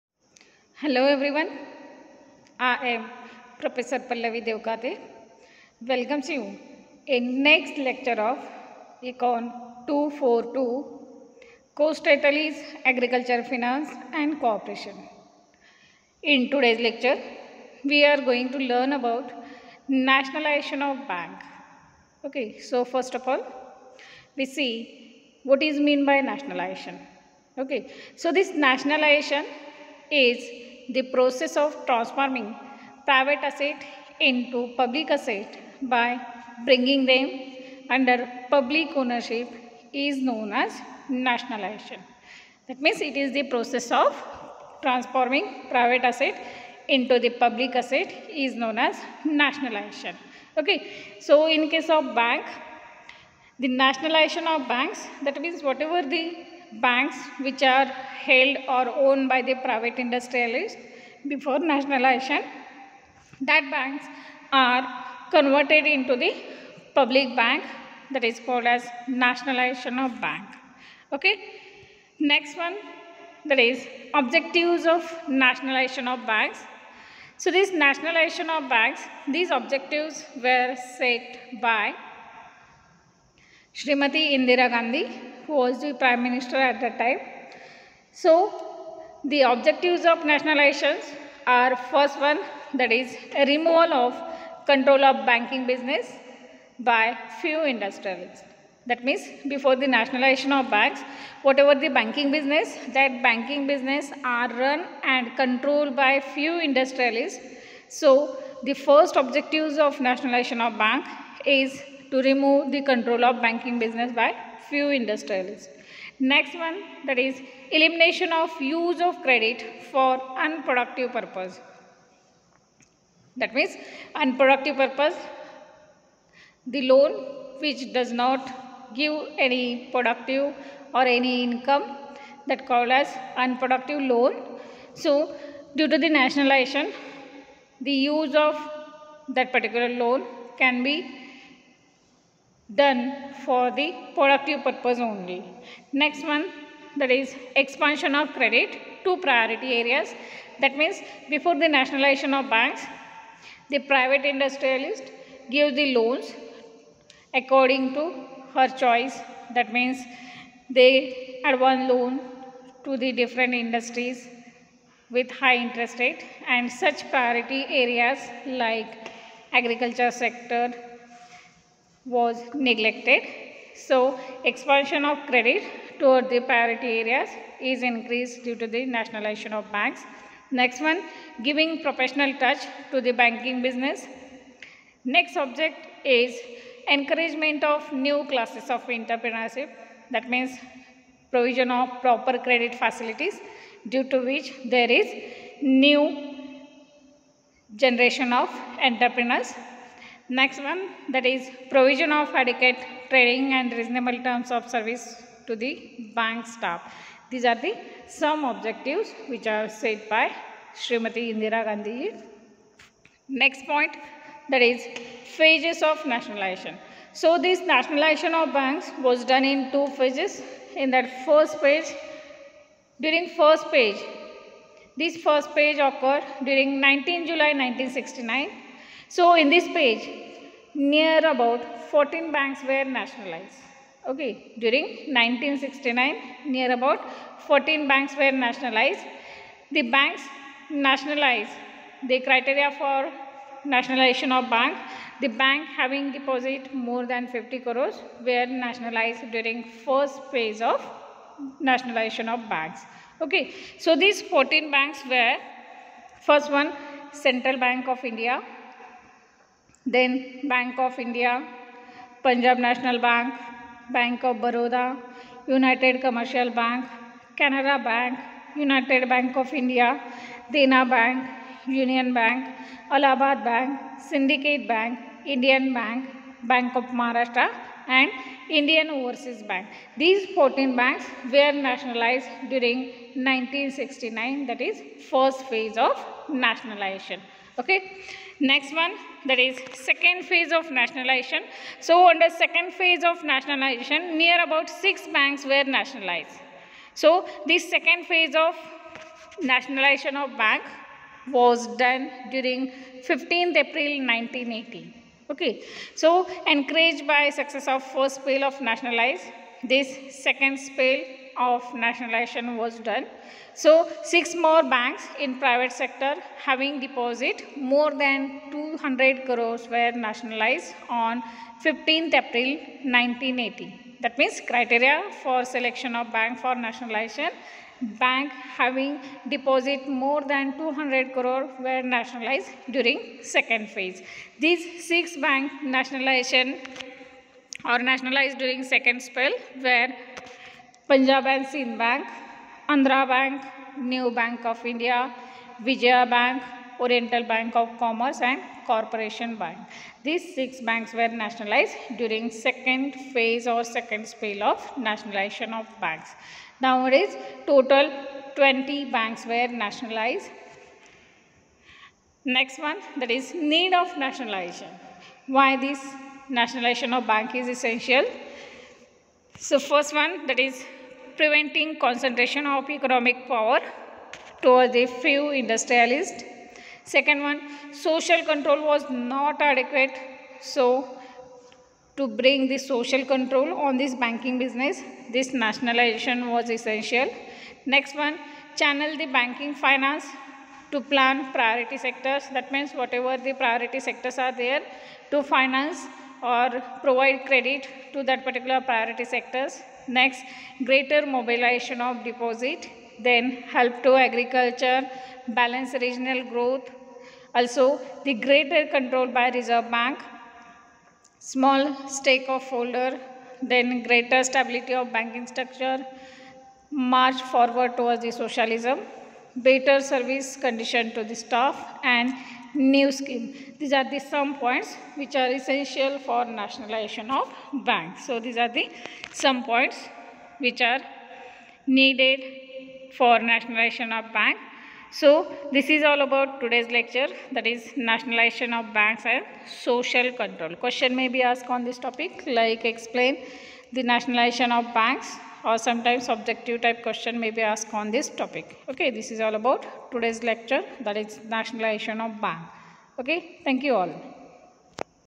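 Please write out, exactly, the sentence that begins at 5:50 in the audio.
These six banks were nationalized during second phase or second spell of nationalization of banks.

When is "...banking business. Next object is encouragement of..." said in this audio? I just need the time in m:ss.
3:03.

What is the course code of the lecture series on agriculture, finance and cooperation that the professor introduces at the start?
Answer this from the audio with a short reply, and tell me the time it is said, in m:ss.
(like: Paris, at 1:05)
Econ 242, at 0:09.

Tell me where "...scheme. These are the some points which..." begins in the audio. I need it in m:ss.
7:02.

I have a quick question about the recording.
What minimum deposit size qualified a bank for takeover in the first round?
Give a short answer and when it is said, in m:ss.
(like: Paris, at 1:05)
50 crores, at 4:07.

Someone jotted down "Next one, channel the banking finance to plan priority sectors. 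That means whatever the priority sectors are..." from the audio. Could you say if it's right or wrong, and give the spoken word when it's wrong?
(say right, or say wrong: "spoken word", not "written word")
right.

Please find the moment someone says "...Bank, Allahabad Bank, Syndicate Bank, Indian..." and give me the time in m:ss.
4:32.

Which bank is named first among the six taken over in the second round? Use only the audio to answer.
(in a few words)
Punjab and Sind Bank.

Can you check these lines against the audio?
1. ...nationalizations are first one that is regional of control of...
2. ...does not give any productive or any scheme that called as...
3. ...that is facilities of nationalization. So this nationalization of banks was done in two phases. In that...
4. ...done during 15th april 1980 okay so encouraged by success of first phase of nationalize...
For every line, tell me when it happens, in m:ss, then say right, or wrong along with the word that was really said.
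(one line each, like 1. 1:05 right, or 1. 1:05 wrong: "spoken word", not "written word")
1. 1:30 wrong: "removal", not "regional"
2. 2:07 wrong: "income", not "scheme"
3. 3:34 wrong: "phases", not "facilities"
4. 5:01 right.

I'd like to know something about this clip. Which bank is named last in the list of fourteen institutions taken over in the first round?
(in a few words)
Indian Overseas Bank.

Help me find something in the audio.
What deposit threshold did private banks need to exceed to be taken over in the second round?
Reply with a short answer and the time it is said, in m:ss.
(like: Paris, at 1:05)
200 crores, at 5:18.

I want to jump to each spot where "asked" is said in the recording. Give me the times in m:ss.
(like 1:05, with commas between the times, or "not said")
7:21, 7:27.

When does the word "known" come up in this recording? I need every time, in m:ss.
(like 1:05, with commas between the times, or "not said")
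0:40, 0:48.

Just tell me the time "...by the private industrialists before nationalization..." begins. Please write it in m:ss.
0:59.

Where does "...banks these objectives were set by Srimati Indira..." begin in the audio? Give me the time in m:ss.
1:18.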